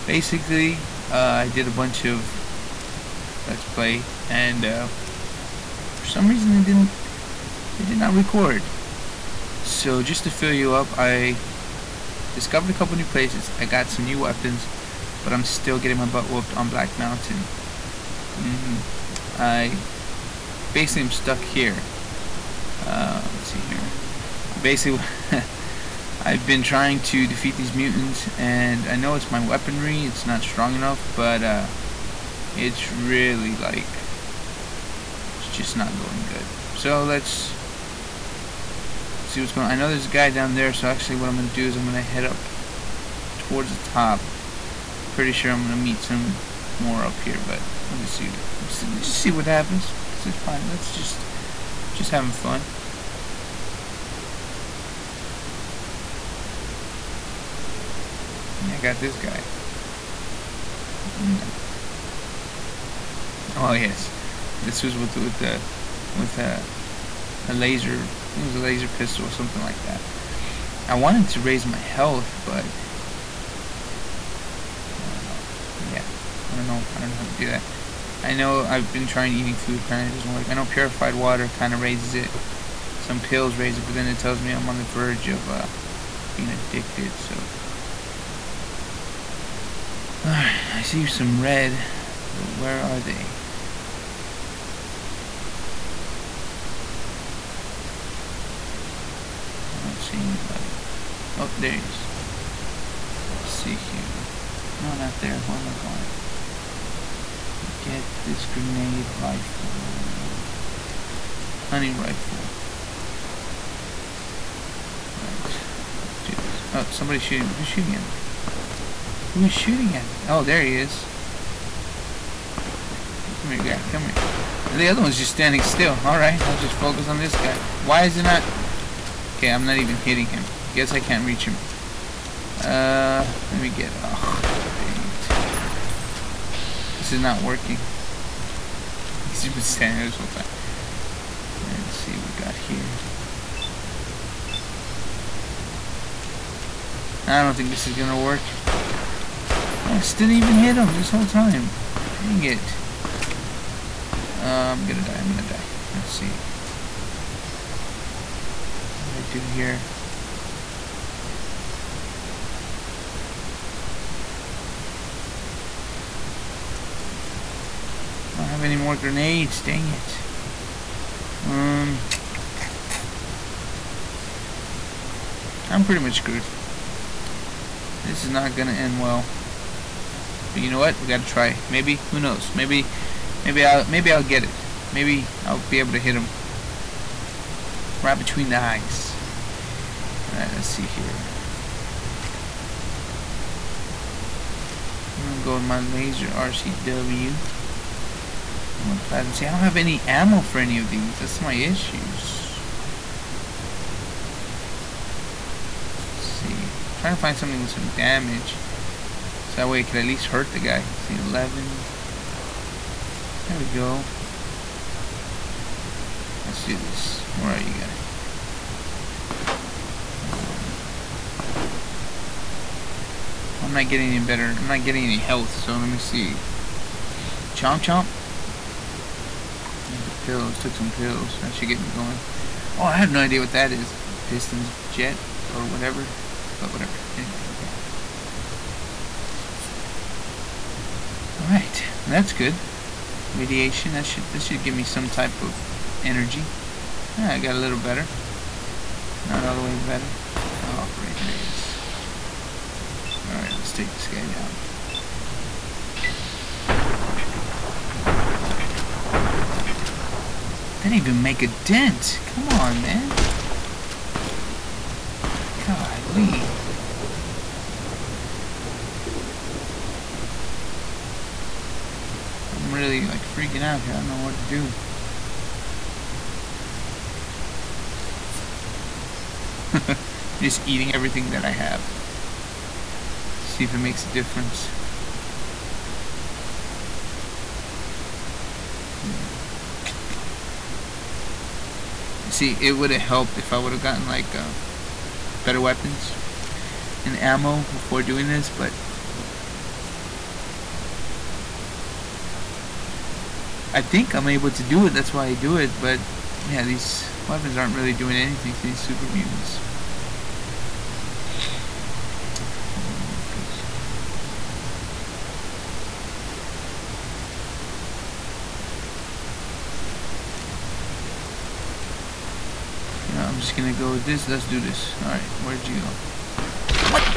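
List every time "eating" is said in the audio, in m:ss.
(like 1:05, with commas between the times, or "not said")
1:19, 4:40.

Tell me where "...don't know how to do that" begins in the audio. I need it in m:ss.
1:16.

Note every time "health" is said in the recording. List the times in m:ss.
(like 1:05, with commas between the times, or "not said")
1:11, 3:45.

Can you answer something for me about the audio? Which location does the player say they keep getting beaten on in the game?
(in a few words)
Black Mountain.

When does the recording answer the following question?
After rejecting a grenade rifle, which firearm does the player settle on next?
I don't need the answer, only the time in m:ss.
1:51.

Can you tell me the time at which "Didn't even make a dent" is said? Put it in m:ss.
4:20.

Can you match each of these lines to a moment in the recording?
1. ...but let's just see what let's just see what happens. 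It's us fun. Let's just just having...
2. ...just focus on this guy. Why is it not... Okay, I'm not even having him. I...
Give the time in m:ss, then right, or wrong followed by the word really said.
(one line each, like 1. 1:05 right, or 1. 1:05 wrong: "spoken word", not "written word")
1. 0:47 right
2. 2:06 wrong: "hitting", not "having".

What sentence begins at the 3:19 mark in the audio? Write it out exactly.
See, I don't have any ammo for any of these.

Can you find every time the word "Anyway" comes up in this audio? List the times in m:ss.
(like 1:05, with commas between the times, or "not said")
3:57.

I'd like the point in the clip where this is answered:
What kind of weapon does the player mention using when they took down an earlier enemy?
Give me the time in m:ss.
1:08.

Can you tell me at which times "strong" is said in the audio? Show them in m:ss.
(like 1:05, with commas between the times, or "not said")
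0:30.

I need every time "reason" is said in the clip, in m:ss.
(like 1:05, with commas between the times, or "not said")
0:06.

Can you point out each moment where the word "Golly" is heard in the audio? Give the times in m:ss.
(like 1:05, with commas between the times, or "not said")
4:25.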